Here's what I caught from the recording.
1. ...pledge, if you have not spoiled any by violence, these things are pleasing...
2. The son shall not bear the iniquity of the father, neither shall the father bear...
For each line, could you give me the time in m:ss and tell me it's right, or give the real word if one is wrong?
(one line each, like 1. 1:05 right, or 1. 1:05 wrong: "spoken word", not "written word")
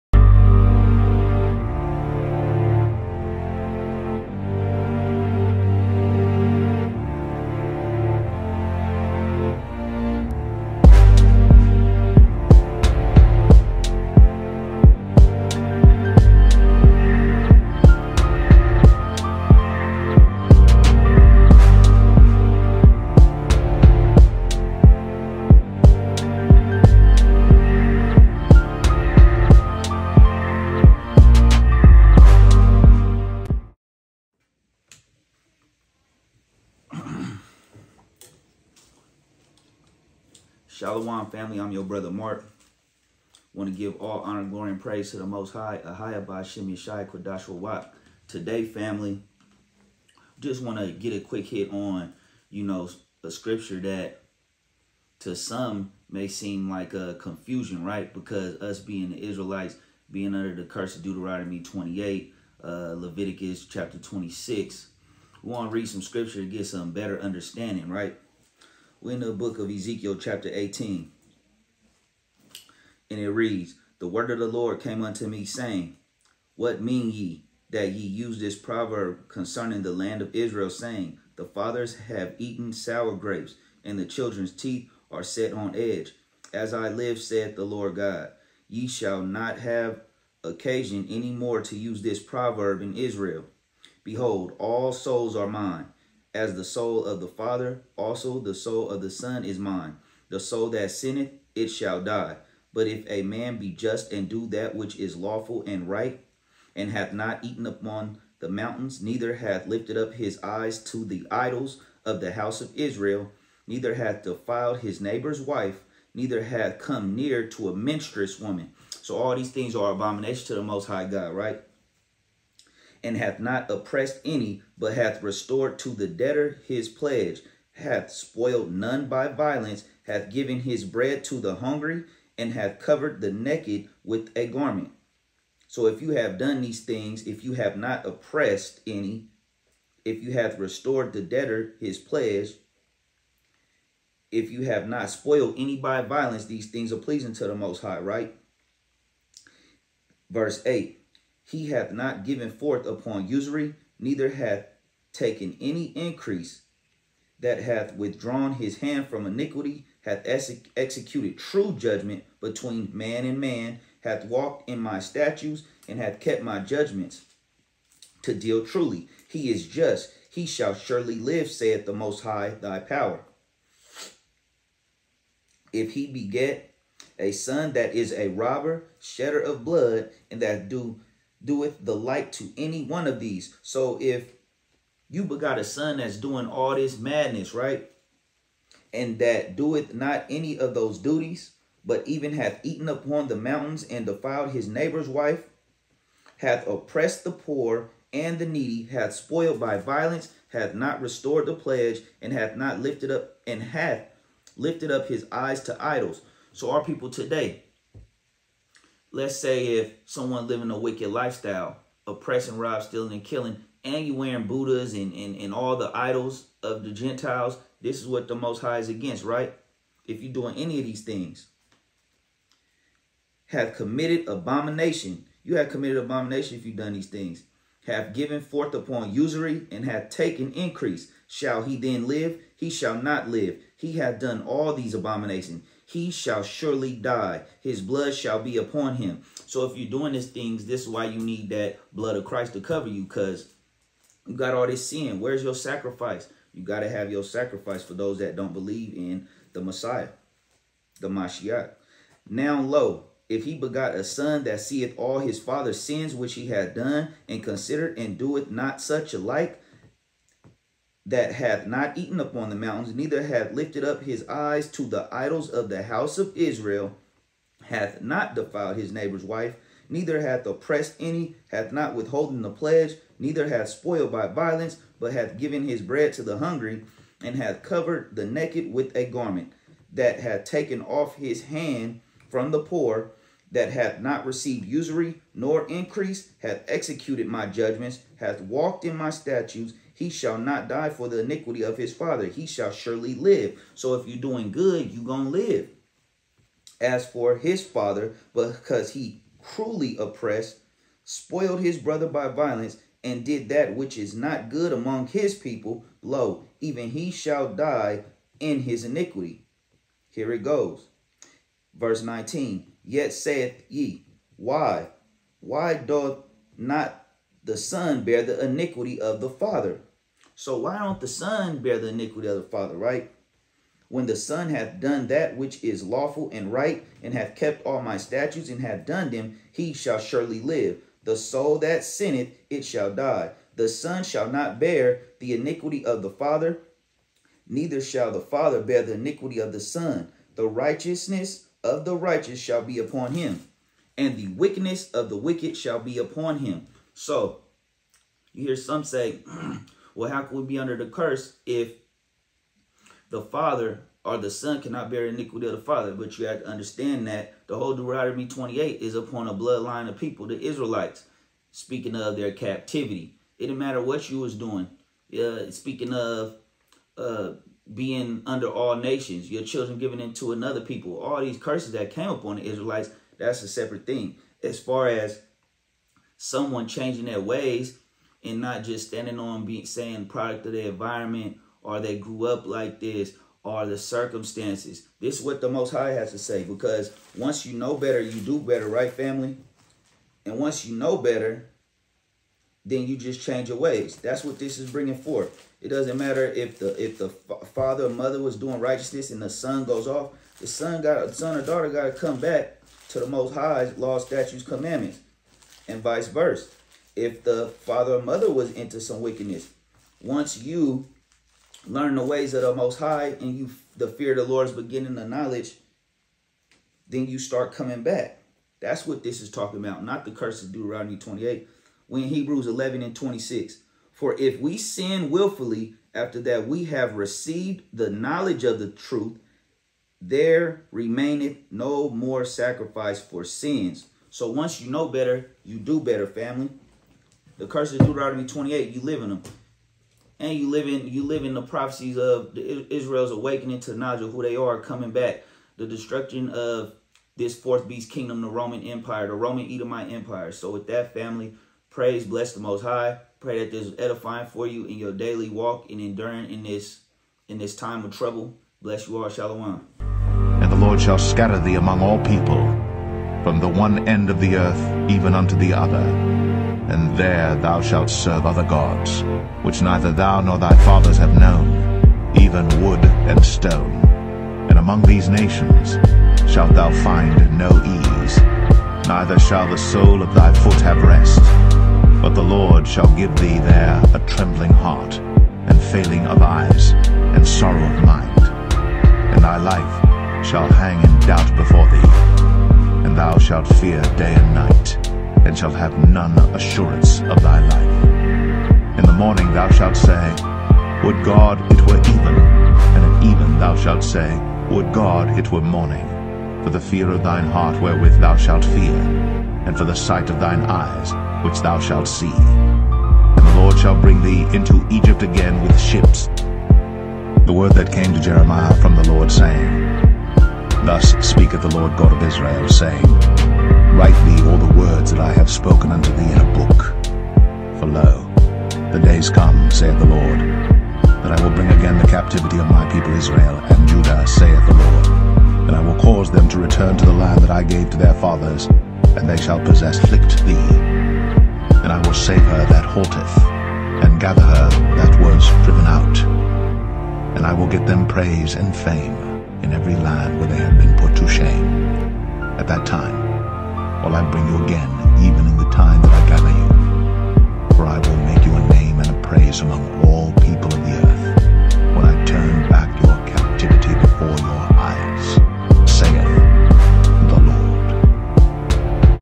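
1. 2:21 right
2. 5:33 right.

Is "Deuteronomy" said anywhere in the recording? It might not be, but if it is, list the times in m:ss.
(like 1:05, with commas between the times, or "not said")
1:01, 5:57, 7:00, 7:17.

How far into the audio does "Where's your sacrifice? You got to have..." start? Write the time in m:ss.
4:05.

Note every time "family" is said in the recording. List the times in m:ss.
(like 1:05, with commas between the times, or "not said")
0:41, 0:48, 6:28, 7:16, 7:30.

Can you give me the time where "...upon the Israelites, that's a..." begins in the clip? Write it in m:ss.
6:12.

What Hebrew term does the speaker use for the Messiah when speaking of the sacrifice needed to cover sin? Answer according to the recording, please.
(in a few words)
Mashiach.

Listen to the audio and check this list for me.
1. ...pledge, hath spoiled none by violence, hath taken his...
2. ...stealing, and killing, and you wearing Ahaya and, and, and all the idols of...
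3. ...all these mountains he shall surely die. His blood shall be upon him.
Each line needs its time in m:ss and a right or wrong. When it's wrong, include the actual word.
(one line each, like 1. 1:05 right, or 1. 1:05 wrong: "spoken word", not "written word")
1. 2:06 wrong: "given", not "taken"
2. 3:32 wrong: "Buddhas", not "Ahaya"
3. 3:54 wrong: "abominations", not "mountains".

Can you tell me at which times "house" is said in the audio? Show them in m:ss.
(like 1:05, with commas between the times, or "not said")
1:52, 4:25.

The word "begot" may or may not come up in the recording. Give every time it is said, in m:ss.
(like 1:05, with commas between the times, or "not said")
3:05, 4:13.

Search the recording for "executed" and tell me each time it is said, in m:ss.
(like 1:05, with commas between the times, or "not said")
2:40, 4:46.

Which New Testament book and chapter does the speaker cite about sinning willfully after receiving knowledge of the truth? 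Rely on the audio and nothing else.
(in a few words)
Hebrews 11.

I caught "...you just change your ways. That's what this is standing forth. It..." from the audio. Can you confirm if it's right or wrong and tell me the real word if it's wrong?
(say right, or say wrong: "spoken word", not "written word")
wrong: "bringing", not "standing".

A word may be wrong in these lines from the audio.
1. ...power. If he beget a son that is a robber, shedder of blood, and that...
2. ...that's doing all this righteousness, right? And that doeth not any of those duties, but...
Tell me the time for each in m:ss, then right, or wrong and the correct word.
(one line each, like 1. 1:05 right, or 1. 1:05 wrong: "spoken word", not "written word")
1. 2:52 right
2. 3:05 wrong: "madness", not "righteousness".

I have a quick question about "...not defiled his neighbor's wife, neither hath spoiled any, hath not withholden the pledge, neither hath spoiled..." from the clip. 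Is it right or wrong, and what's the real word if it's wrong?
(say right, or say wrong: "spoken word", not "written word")
wrong: "oppressed", not "spoiled".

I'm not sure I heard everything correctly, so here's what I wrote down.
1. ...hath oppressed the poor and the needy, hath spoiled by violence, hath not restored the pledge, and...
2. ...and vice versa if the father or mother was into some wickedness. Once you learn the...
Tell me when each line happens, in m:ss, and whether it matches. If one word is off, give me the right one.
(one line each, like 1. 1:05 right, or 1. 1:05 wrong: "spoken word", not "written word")
1. 3:16 right
2. 6:45 right.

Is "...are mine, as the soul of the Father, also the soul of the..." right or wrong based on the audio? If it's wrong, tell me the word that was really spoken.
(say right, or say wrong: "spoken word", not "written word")
right.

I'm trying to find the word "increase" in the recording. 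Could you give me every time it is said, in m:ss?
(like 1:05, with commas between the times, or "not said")
2:35, 3:50, 4:45.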